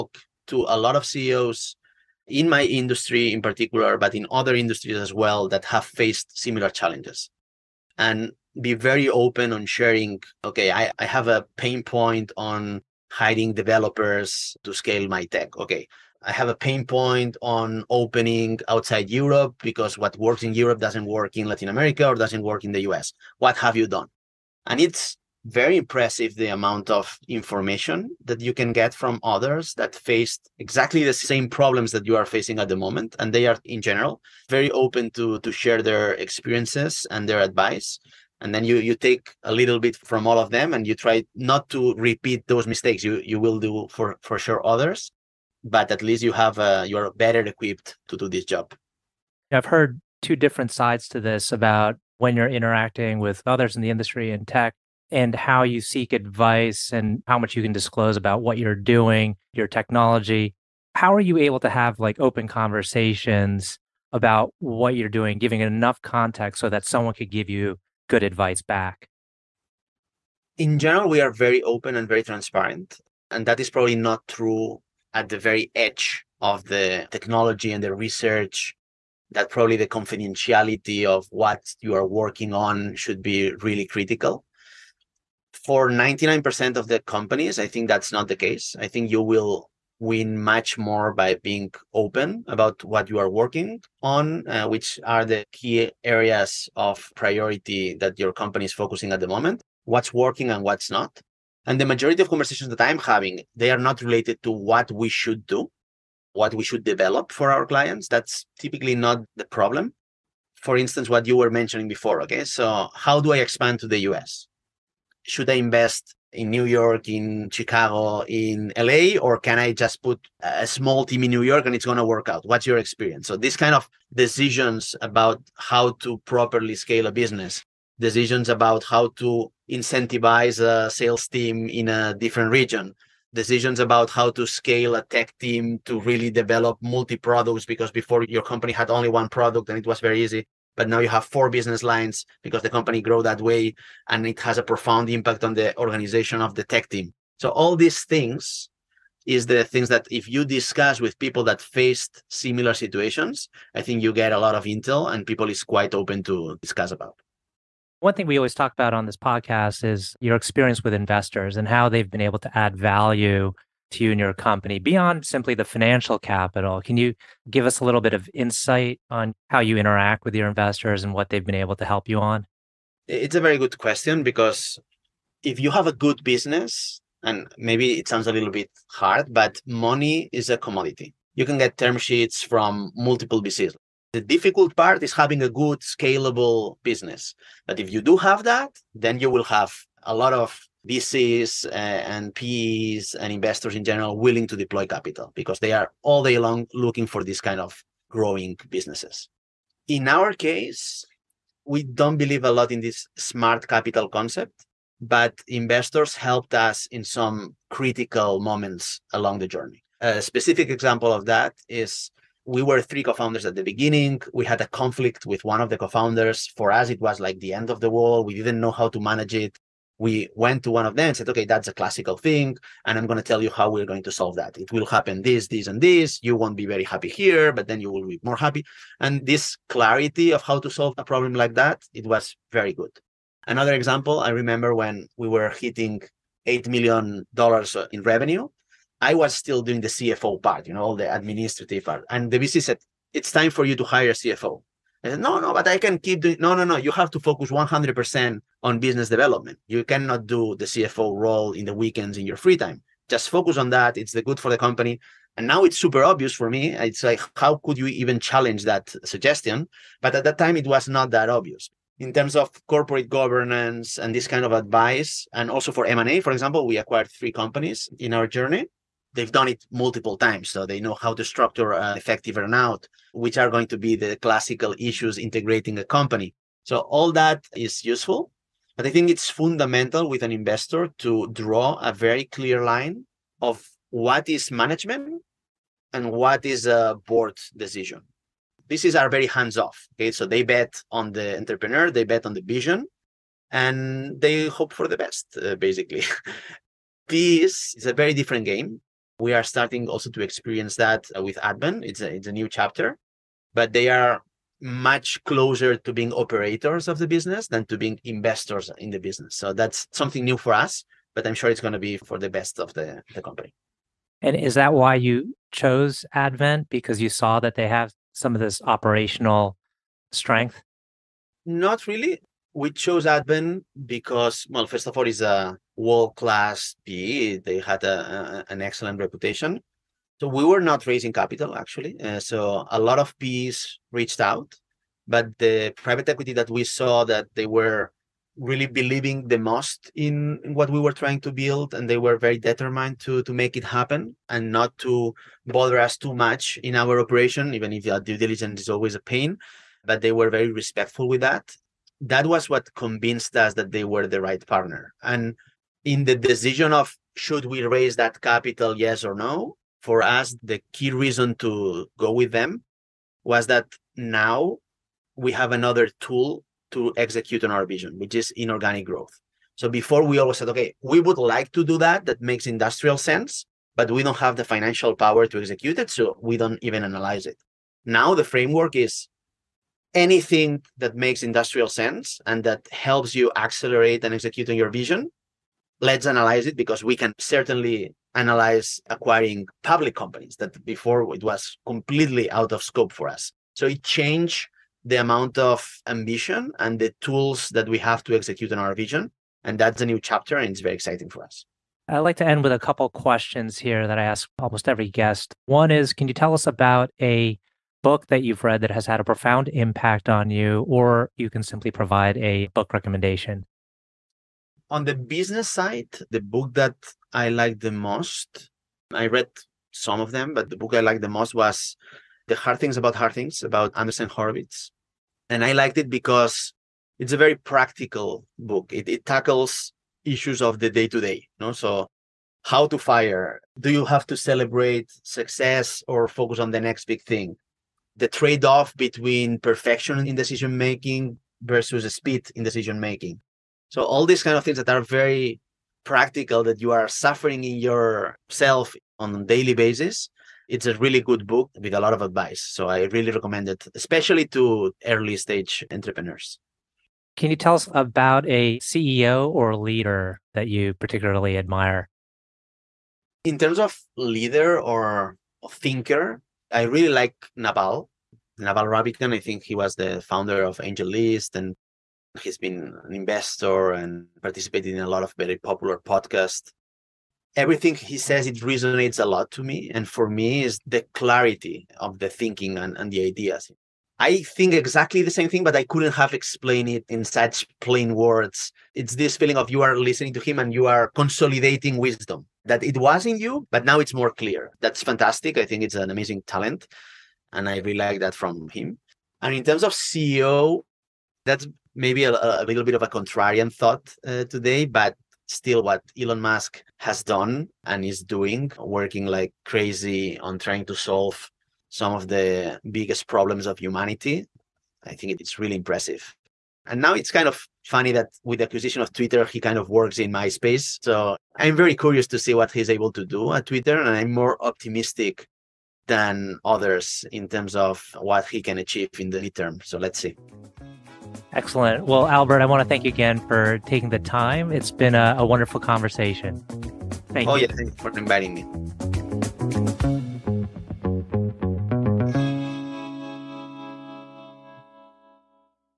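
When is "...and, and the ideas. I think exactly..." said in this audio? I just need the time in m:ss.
8:02.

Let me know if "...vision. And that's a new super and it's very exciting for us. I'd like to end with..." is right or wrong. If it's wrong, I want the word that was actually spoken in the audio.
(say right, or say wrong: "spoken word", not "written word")
wrong: "chapter", not "super".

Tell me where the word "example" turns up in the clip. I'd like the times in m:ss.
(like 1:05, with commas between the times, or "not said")
3:30, 3:53, 4:26.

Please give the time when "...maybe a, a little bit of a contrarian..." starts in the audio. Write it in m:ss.
8:21.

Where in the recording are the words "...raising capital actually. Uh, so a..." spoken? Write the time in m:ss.
5:30.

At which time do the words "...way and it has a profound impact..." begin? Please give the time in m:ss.
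2:23.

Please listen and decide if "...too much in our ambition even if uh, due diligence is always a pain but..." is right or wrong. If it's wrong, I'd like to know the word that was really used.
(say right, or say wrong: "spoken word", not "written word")
wrong: "operation", not "ambition".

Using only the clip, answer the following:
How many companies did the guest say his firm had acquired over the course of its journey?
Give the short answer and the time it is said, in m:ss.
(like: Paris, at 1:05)
3, at 4:27.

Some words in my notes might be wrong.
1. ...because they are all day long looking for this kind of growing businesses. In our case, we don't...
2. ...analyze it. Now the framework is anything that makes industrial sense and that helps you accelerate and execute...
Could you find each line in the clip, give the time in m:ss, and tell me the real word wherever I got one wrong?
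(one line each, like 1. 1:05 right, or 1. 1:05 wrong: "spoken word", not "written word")
1. 3:15 right
2. 6:16 right.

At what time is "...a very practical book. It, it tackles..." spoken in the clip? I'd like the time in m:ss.
7:07.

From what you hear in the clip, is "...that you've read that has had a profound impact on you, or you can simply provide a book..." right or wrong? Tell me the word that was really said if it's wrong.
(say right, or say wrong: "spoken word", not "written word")
right.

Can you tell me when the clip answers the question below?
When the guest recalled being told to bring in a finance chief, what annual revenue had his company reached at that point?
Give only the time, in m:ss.
3:56.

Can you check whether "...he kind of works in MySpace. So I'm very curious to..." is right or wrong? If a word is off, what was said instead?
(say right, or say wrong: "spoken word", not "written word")
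right.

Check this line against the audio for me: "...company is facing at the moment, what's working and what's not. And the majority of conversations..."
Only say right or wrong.
wrong.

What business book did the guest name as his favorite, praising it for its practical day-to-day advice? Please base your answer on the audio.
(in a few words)
The Hard Things About Hard Things.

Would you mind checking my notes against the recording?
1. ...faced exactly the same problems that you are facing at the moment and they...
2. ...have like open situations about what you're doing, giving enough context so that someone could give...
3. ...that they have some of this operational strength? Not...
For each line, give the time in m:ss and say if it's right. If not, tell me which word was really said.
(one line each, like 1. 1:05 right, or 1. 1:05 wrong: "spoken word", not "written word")
1. 0:29 right
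2. 1:01 wrong: "conversations", not "situations"
3. 5:17 right.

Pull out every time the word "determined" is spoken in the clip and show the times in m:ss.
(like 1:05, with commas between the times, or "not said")
5:42.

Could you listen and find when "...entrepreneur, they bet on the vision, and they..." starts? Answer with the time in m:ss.
4:51.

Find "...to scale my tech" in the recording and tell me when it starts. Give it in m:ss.
0:14.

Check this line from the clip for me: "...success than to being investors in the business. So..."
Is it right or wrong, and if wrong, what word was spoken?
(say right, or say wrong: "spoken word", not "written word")
wrong: "business", not "success".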